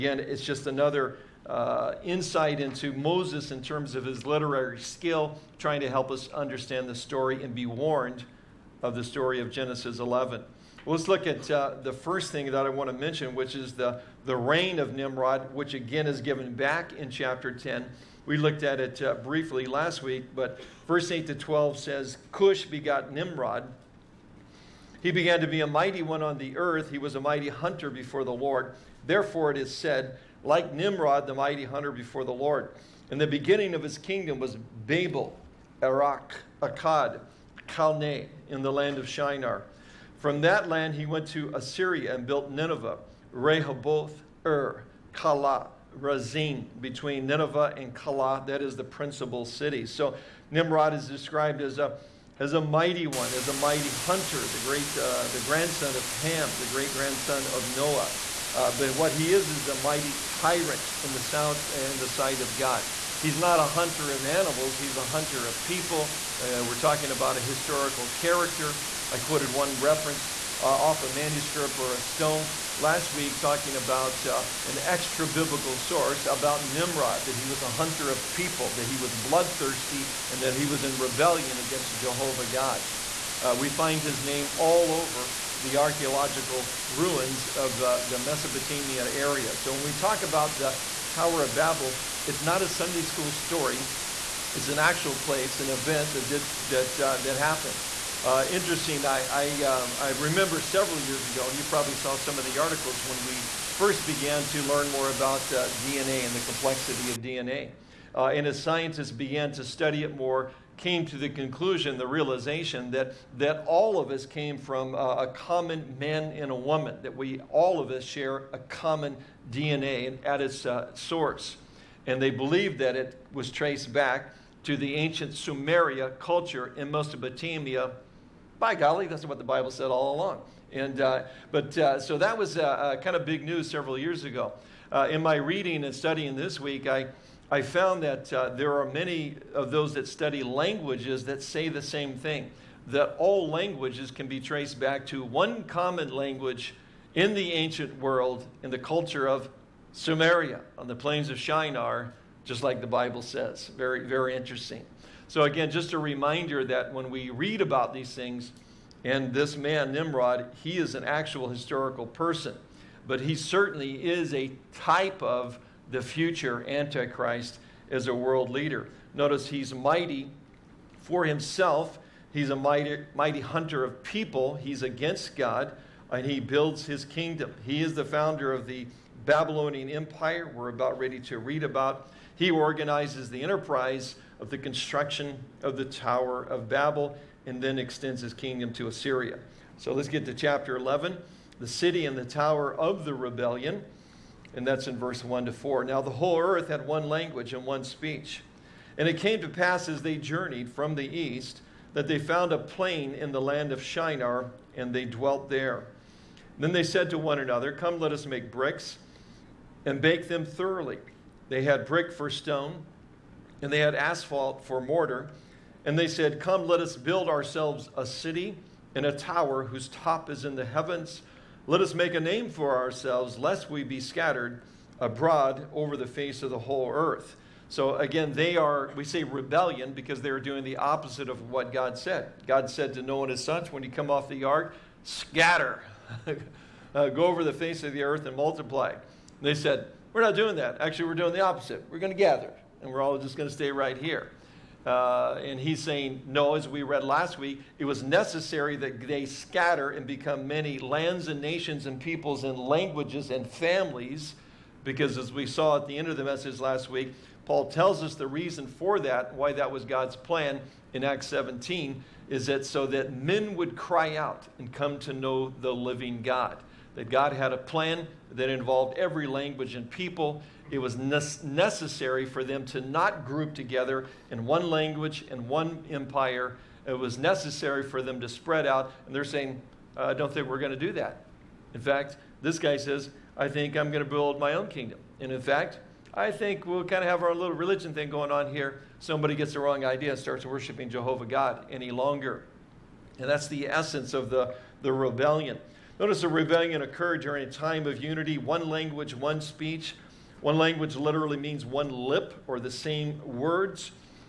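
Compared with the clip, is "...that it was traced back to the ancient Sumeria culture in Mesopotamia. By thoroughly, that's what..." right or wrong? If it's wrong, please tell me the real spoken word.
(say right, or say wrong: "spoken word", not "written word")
wrong: "golly", not "thoroughly".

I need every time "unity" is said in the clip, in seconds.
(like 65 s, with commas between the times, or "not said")
298 s.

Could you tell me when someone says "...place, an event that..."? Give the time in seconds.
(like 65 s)
95 s.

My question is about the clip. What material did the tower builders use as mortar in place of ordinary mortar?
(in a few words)
Asphalt.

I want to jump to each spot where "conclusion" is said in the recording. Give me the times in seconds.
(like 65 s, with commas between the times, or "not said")
111 s.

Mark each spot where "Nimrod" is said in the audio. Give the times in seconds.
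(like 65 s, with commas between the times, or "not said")
14 s, 23 s, 30 s, 50 s, 76 s, 159 s.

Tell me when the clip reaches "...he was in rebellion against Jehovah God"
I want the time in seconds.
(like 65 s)
80 s.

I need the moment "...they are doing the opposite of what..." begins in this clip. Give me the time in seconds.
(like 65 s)
230 s.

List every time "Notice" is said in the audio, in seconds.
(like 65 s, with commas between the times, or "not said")
169 s, 295 s.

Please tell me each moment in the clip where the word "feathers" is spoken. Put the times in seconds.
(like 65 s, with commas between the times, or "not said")
not said.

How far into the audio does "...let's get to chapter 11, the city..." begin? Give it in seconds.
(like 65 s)
189 s.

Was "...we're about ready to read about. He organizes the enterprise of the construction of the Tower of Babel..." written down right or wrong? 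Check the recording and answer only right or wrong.
right.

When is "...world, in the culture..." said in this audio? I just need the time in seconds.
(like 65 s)
147 s.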